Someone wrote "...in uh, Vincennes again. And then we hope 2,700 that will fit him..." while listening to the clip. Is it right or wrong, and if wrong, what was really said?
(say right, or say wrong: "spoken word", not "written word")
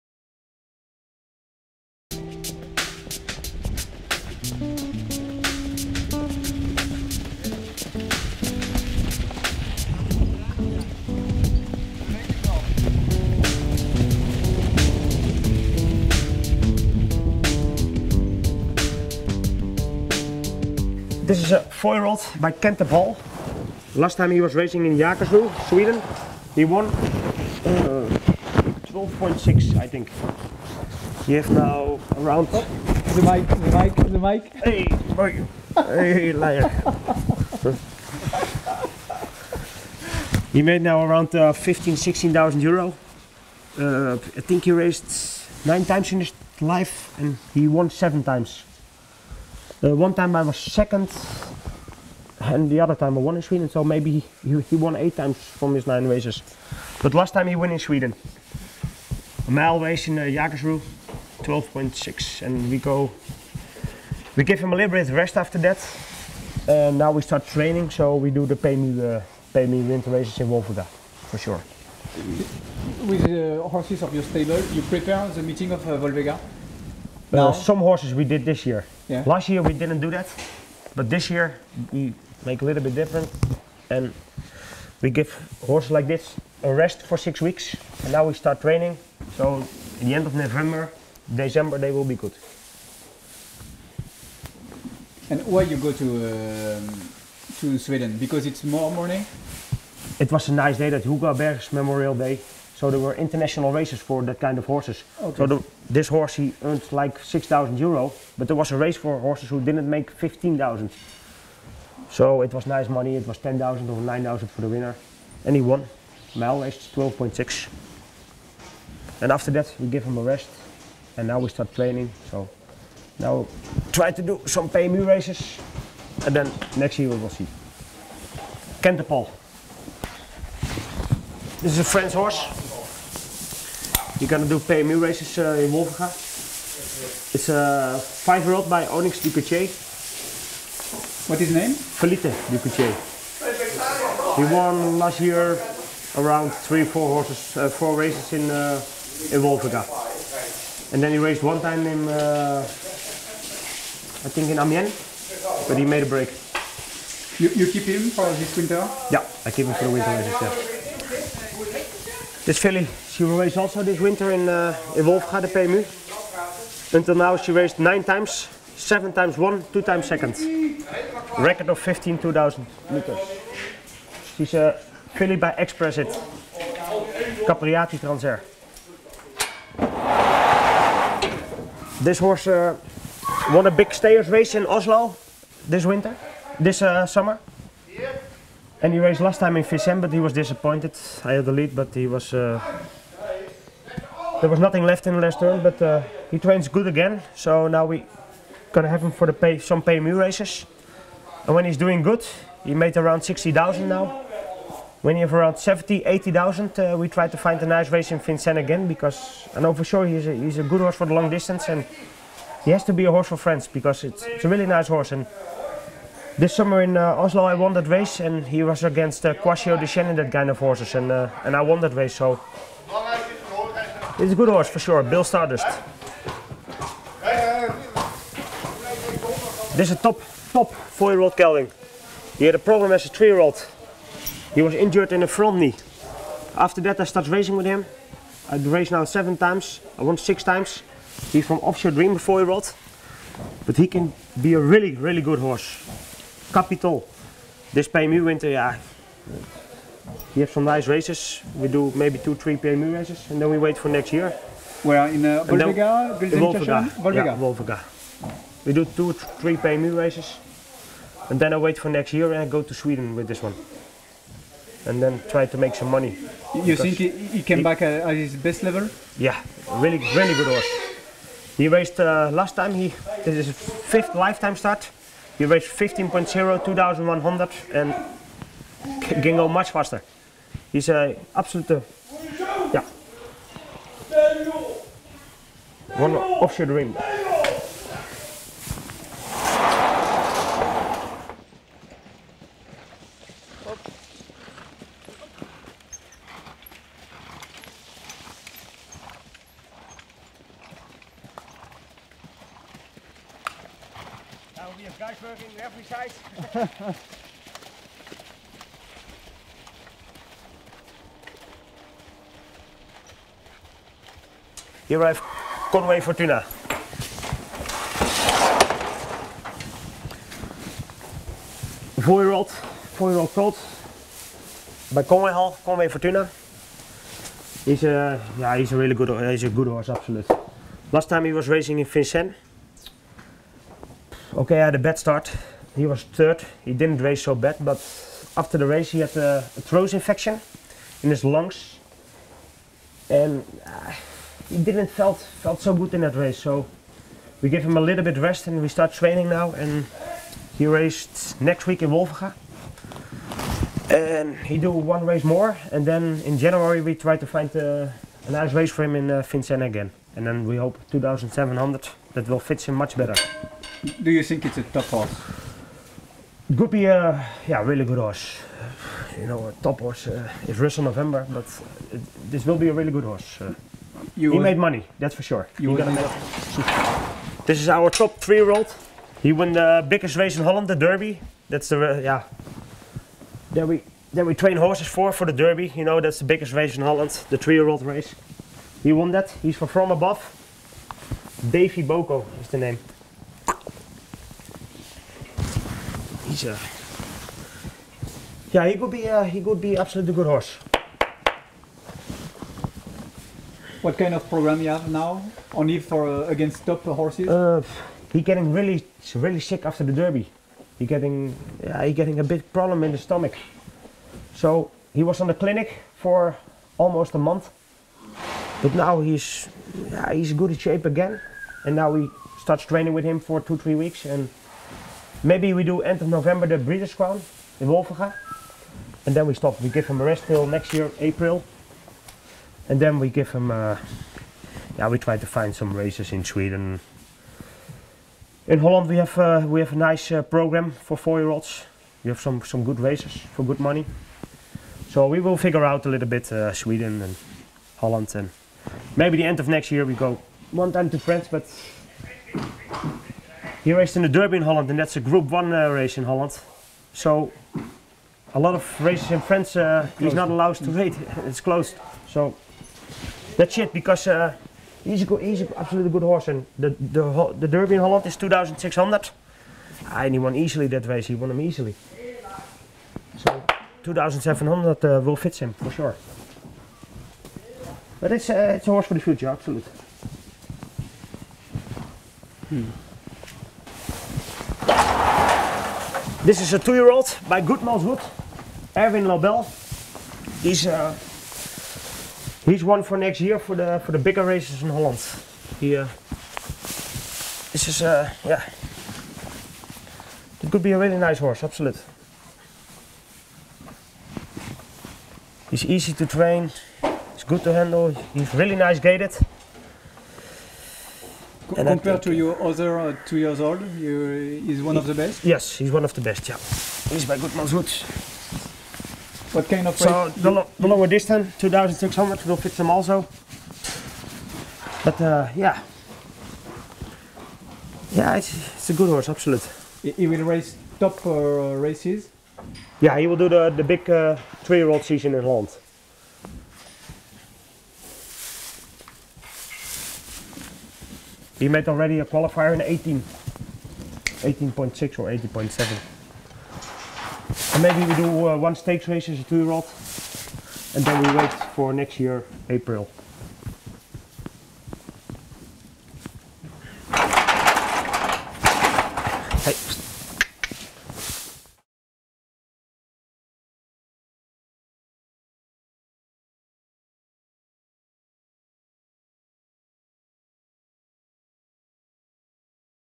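right.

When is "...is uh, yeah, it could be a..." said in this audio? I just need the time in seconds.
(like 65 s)
497 s.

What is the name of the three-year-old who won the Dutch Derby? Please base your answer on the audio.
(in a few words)
Davy Boko.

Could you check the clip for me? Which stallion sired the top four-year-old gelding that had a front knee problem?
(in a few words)
Offshore Dream.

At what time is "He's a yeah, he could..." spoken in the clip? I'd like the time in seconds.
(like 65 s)
396 s.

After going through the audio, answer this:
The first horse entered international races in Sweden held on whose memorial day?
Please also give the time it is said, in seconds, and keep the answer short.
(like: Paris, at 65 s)
Hugo Åbergs, at 101 s.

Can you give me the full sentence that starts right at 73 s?
With the uh, horses of your stable, you prepare the meeting of uh, Wolvega?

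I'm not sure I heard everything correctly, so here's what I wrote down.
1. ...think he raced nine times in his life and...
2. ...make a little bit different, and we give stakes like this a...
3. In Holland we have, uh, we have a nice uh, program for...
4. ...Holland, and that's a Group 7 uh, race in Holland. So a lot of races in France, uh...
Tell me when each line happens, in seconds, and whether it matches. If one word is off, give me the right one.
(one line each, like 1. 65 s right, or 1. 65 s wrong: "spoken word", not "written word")
1. 44 s right
2. 82 s wrong: "horses", not "stakes"
3. 438 s right
4. 454 s wrong: "1", not "7".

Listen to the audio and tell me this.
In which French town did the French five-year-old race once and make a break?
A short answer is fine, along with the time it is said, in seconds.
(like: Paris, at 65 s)
Amiens, at 154 s.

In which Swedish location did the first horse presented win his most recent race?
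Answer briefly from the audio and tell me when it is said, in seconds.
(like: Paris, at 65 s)
Jägersro, at 24 s.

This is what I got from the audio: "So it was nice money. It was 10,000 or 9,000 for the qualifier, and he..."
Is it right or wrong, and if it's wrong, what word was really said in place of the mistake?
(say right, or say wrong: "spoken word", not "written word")
wrong: "winner", not "qualifier".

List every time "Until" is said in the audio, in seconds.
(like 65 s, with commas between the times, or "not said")
166 s.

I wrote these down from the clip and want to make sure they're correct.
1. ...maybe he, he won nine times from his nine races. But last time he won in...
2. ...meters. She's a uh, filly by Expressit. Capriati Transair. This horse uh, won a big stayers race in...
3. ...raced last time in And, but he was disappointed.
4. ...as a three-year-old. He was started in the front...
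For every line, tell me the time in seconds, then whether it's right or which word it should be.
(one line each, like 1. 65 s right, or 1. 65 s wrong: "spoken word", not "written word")
1. 53 s wrong: "eight", not "nine"
2. 172 s right
3. 188 s wrong: "Fisem", not "And"
4. 232 s wrong: "injured", not "started".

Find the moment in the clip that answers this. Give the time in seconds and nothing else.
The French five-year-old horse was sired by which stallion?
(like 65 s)
138 s.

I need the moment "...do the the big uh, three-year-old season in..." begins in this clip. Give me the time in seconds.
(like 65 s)
533 s.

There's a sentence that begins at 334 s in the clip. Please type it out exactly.
okay, I had a bad start.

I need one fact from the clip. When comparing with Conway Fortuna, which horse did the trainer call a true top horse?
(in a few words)
Russell November.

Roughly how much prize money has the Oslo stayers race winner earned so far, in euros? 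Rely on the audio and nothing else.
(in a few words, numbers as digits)
60,000.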